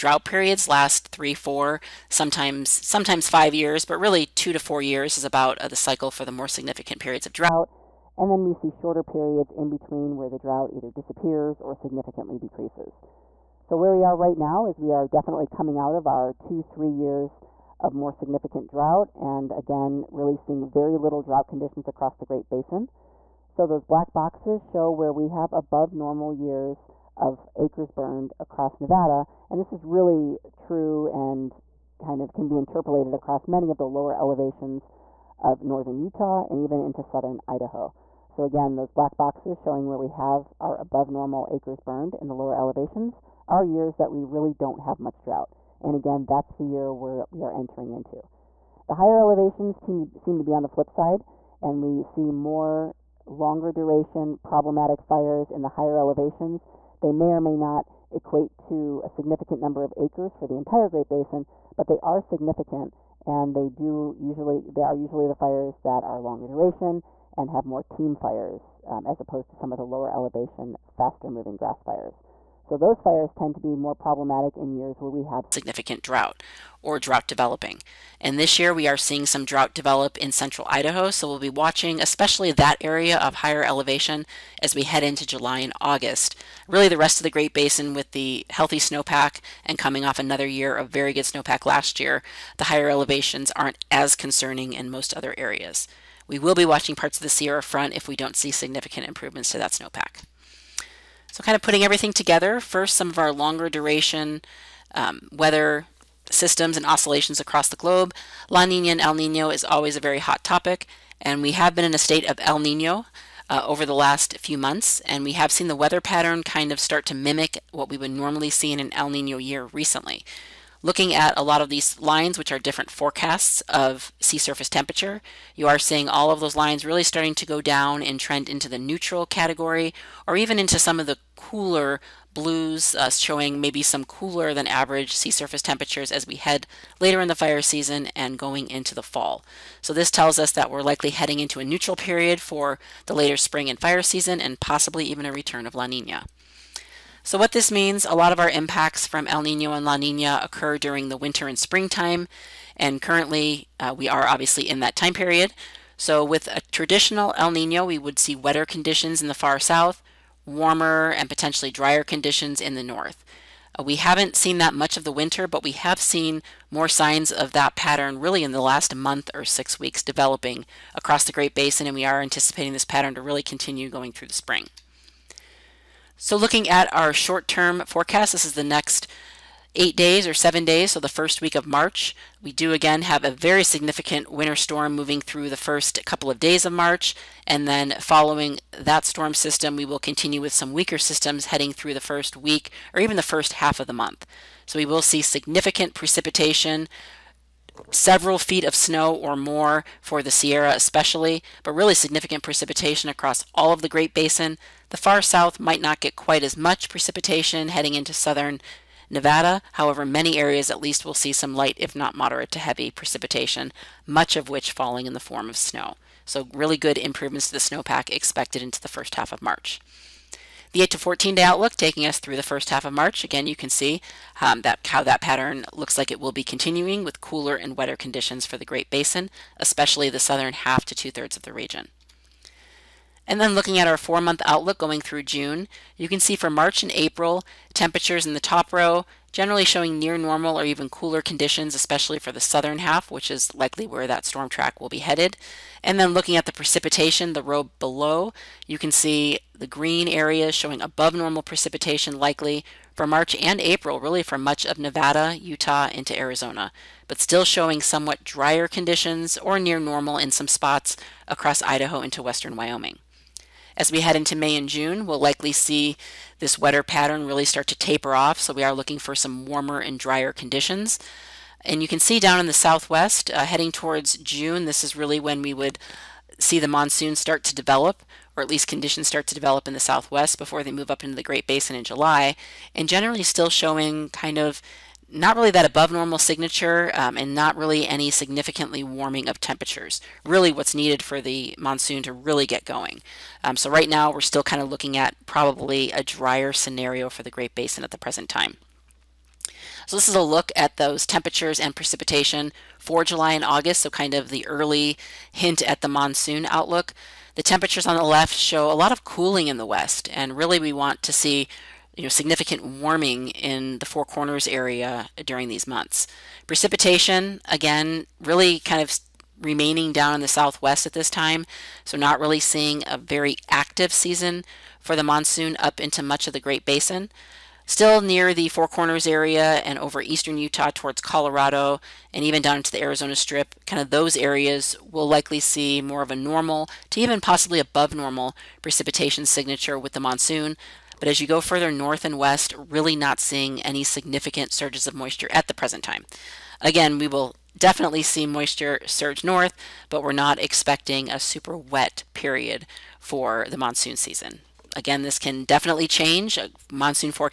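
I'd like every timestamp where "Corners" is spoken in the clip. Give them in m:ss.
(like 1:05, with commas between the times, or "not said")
5:14, 5:28.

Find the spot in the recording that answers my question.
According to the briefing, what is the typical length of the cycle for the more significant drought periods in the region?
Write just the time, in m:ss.
0:04.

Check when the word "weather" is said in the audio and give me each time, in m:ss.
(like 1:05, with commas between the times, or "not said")
1:45, 1:55.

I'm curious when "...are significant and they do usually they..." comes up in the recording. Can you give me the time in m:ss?
1:01.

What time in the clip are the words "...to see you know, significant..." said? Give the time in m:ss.
5:11.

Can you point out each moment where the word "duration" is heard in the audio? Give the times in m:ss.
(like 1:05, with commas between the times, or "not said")
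0:53, 1:06, 1:43.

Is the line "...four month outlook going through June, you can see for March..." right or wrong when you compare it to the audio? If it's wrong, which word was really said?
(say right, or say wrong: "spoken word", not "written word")
right.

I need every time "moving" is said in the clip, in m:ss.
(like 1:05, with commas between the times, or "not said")
1:11, 3:04.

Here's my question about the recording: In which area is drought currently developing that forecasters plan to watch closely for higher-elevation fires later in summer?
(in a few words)
central Idaho.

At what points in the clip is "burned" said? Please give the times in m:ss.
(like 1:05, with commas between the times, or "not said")
0:27, 0:41.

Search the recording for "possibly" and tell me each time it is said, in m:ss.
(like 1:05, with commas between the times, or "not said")
2:24, 5:37.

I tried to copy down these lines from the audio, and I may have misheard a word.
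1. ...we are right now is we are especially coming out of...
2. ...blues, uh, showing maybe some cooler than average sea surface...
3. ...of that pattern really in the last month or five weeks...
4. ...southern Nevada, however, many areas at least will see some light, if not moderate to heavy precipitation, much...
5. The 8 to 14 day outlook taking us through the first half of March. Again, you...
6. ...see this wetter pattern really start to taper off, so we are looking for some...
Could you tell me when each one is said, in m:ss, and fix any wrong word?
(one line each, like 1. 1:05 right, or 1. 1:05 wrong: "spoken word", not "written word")
1. 0:13 wrong: "definitely", not "especially"
2. 2:12 right
3. 2:47 wrong: "six", not "five"
4. 3:28 right
5. 3:40 right
6. 4:25 right.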